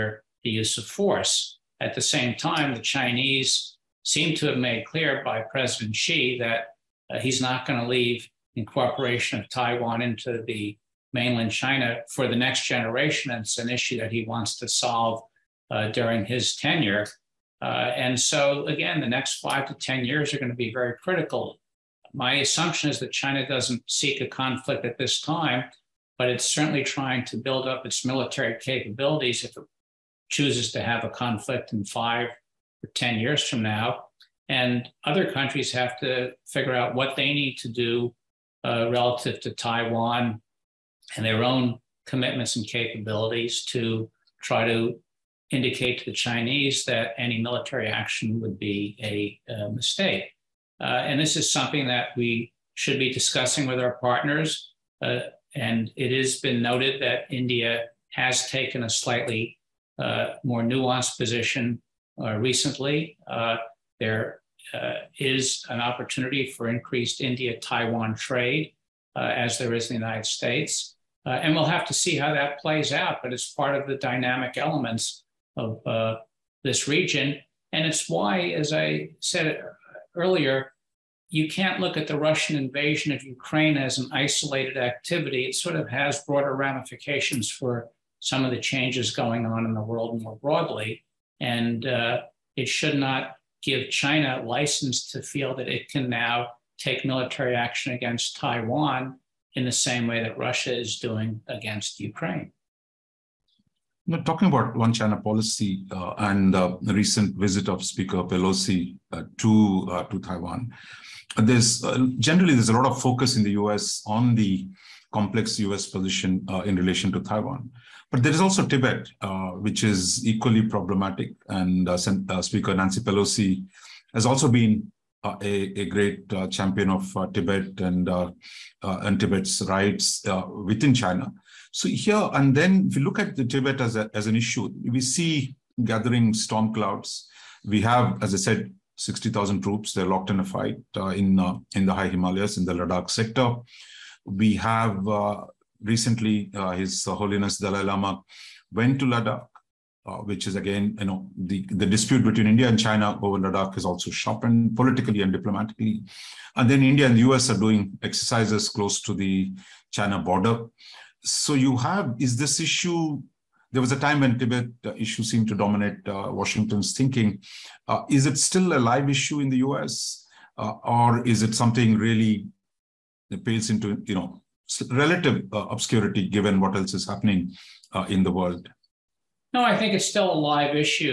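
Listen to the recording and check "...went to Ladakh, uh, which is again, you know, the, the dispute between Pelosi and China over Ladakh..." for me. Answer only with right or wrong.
wrong.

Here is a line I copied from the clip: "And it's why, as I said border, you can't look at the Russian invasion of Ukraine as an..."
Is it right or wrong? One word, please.
wrong.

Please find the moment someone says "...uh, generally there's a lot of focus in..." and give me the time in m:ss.
1:51.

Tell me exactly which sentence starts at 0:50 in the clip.
Uh, and this is something that we should be discussing with our partners.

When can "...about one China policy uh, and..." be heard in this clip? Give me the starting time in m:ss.
1:44.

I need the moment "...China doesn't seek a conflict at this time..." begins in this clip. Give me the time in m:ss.
0:23.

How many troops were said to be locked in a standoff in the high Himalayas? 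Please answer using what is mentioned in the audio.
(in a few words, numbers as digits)
60,000.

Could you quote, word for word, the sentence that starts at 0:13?
And it's an issue that he wants to solve uh, during his tenure.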